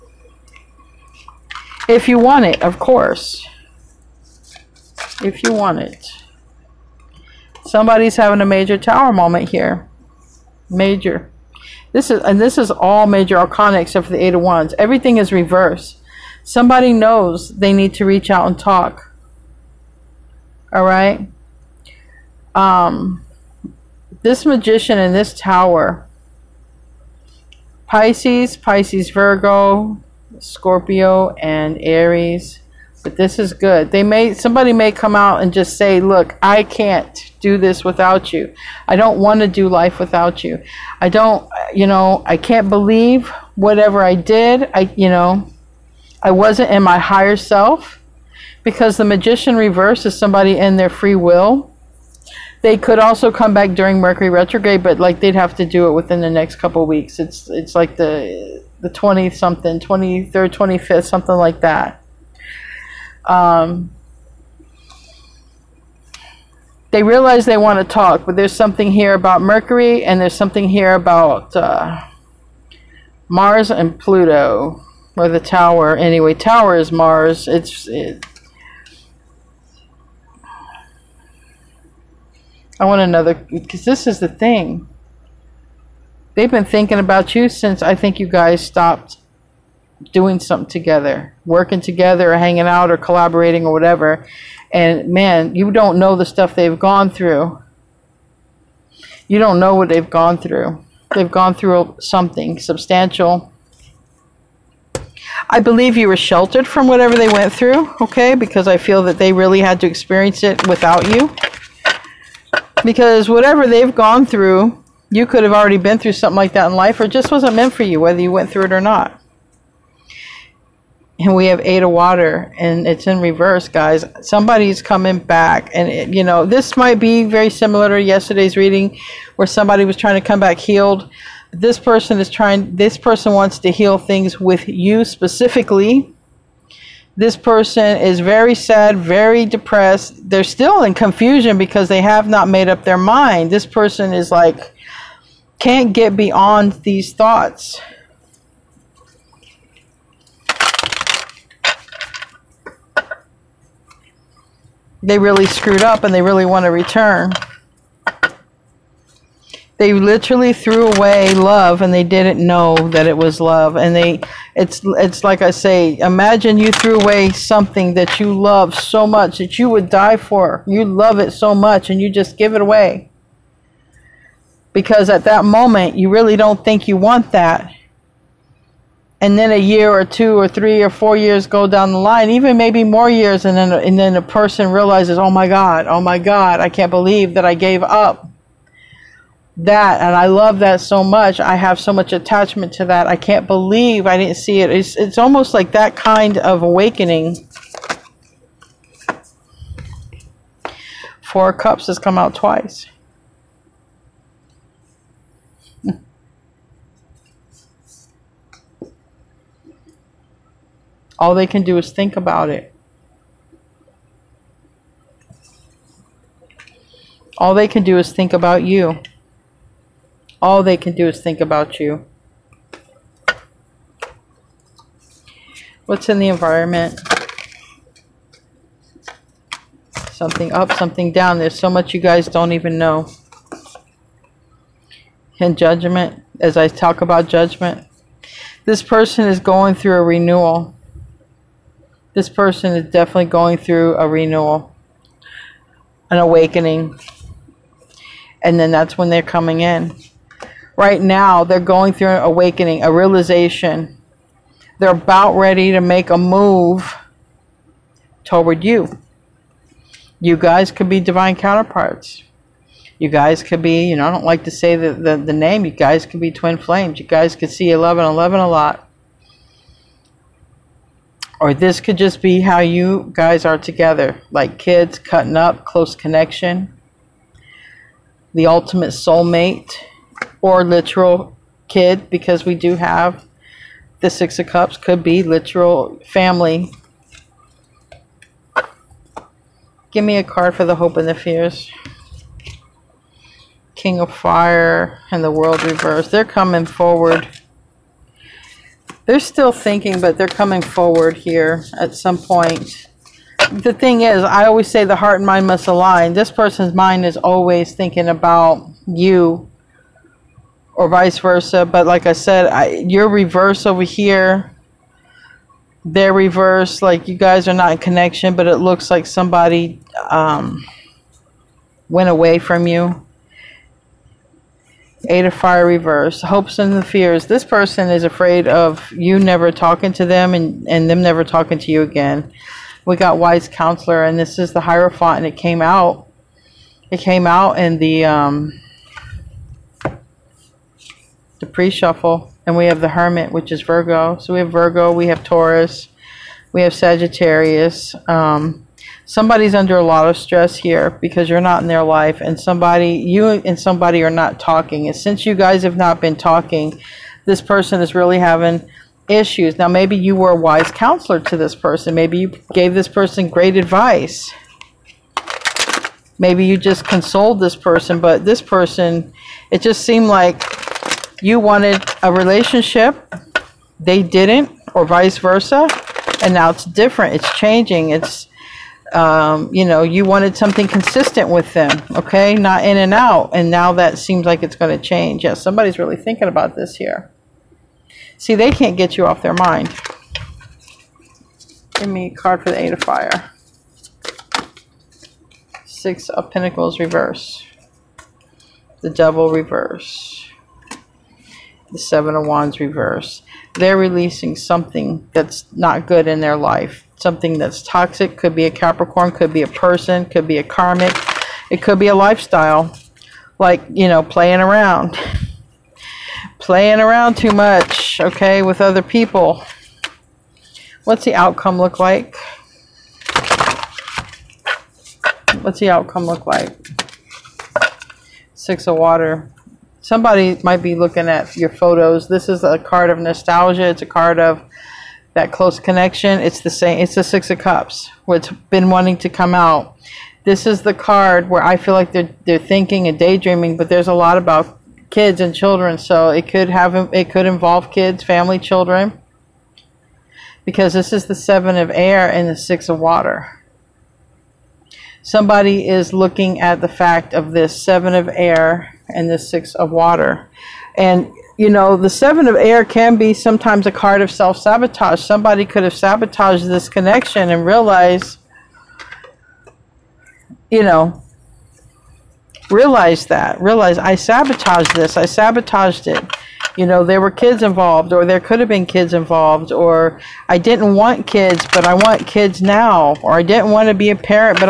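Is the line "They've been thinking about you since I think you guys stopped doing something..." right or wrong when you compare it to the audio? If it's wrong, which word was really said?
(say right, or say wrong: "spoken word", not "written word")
right.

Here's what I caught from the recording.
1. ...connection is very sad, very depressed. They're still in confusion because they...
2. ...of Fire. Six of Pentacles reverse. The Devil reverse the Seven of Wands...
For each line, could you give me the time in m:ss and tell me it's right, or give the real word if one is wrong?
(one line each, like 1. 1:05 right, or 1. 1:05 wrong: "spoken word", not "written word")
1. 2:17 wrong: "person", not "connection"
2. 6:32 right.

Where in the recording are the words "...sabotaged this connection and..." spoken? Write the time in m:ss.
7:45.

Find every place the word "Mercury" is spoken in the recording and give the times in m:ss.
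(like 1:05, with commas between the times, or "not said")
0:53, 1:09.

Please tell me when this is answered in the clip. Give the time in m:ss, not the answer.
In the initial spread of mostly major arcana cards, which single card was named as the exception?
0:14.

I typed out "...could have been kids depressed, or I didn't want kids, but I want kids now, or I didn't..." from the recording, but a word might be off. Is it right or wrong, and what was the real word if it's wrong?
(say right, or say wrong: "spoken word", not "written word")
wrong: "involved", not "depressed".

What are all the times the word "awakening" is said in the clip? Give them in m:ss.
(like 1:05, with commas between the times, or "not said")
3:16, 4:06, 4:12.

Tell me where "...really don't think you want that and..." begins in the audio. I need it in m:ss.
2:56.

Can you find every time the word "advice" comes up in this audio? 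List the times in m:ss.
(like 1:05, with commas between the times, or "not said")
6:03.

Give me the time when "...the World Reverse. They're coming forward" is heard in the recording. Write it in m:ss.
4:55.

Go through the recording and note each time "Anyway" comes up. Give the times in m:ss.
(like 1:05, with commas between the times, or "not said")
1:15.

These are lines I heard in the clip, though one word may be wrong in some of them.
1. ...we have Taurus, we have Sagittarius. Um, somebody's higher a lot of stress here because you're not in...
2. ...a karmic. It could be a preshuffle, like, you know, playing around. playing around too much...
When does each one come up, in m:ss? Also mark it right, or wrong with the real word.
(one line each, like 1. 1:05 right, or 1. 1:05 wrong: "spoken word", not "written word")
1. 5:44 wrong: "under", not "higher"
2. 6:50 wrong: "lifestyle", not "preshuffle".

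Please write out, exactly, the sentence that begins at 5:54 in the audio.
And since you guys have not been talking, this person is really having issues.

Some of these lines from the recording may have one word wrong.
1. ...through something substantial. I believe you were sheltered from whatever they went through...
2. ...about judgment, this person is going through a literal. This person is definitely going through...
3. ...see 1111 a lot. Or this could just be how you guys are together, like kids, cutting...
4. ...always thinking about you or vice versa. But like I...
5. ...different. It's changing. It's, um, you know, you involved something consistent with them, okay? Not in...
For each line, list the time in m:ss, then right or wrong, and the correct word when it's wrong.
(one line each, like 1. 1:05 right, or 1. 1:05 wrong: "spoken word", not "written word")
1. 1:41 right
2. 3:57 wrong: "renewal", not "literal"
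3. 4:27 right
4. 5:07 right
5. 6:16 wrong: "wanted", not "involved".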